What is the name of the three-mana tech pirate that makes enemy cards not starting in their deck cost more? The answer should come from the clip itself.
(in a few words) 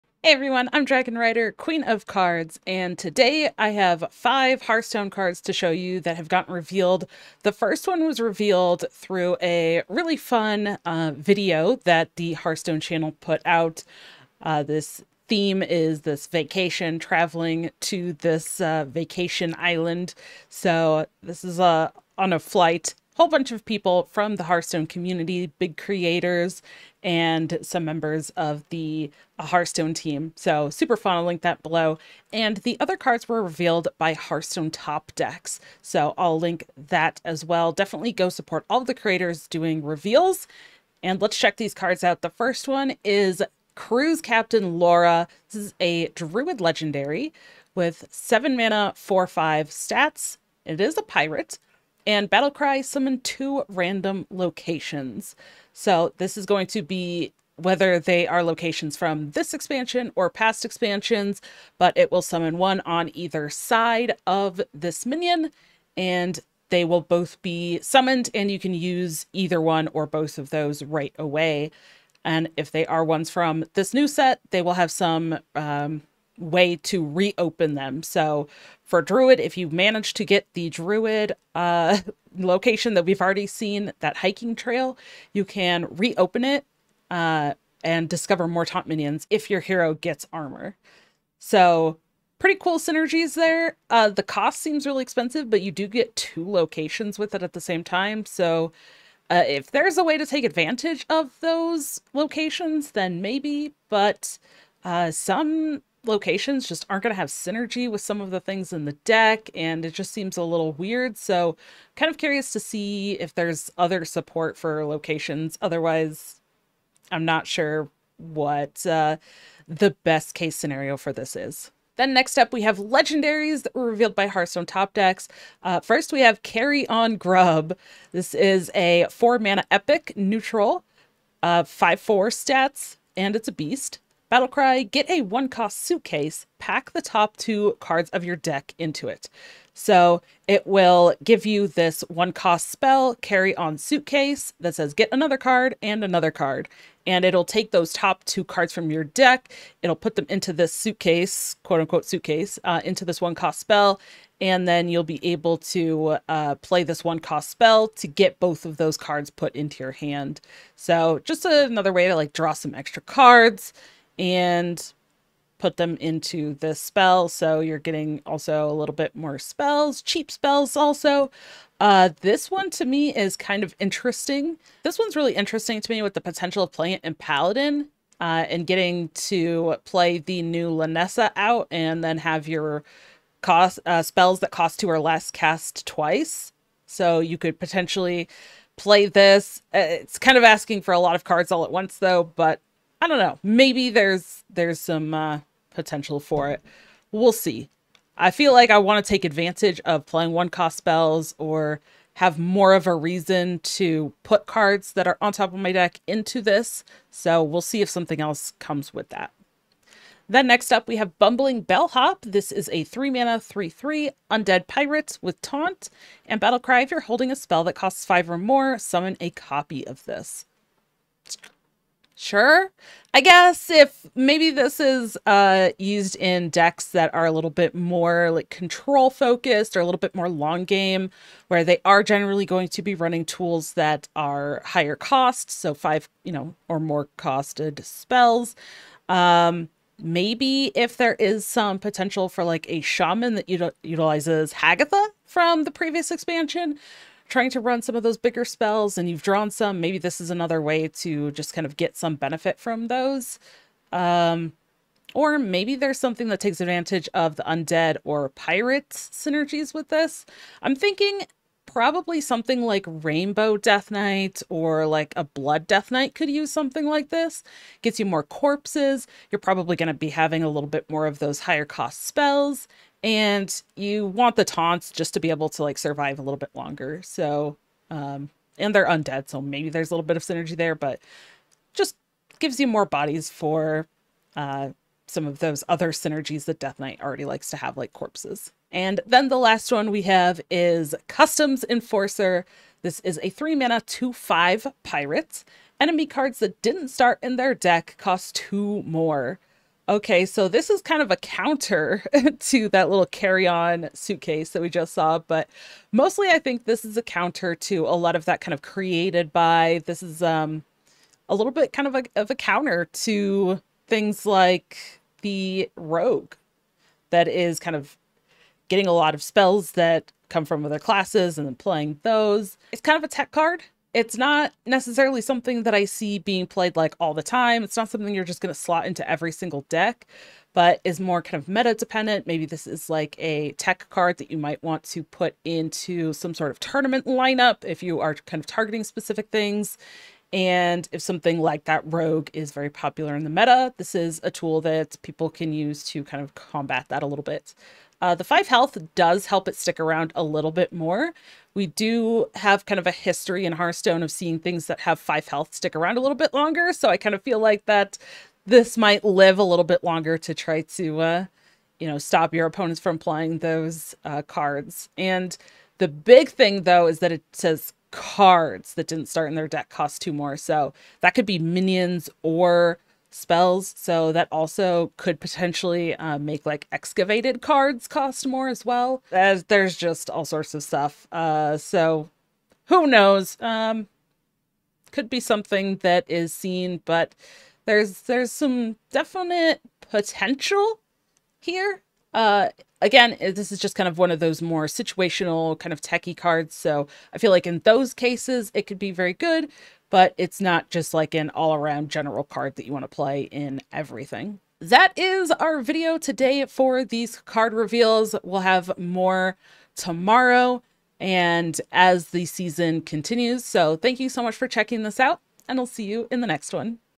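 Customs Enforcer.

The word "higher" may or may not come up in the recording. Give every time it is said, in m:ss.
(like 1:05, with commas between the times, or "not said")
3:54, 4:31.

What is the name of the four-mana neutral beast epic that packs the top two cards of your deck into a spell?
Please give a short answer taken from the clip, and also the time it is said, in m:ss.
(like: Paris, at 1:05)
Carry On Grub, at 2:06.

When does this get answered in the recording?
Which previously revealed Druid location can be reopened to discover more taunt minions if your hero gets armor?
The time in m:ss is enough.
1:24.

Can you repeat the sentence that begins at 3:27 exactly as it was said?
So we'll see if something else comes with that.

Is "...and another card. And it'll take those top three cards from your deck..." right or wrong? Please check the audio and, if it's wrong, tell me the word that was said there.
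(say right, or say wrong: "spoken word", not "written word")
wrong: "two", not "three".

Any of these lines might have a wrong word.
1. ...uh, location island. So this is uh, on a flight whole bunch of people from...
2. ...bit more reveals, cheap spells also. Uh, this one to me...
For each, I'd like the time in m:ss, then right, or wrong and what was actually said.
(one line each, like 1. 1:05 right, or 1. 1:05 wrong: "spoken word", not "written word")
1. 0:18 wrong: "vacation", not "location"
2. 2:48 wrong: "spells", not "reveals".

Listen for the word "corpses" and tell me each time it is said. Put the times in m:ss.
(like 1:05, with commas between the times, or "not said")
4:28, 4:47.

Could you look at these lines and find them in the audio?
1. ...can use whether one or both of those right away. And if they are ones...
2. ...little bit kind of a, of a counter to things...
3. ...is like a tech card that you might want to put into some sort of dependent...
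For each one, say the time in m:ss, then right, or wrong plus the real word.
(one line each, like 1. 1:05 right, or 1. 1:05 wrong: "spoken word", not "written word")
1. 1:08 wrong: "either", not "whether"
2. 5:11 right
3. 5:32 wrong: "tournament", not "dependent".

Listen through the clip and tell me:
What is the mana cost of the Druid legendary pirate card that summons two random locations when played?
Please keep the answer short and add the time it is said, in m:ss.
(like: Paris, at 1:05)
7, at 0:48.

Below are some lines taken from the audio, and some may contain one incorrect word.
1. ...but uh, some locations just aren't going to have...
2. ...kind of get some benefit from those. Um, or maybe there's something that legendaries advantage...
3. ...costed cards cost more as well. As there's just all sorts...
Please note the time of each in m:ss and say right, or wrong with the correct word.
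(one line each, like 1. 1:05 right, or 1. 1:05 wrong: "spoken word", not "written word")
1. 1:43 right
2. 4:11 wrong: "takes", not "legendaries"
3. 6:16 wrong: "excavated", not "costed".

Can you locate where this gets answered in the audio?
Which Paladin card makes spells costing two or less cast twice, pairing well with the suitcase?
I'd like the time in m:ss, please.
3:00.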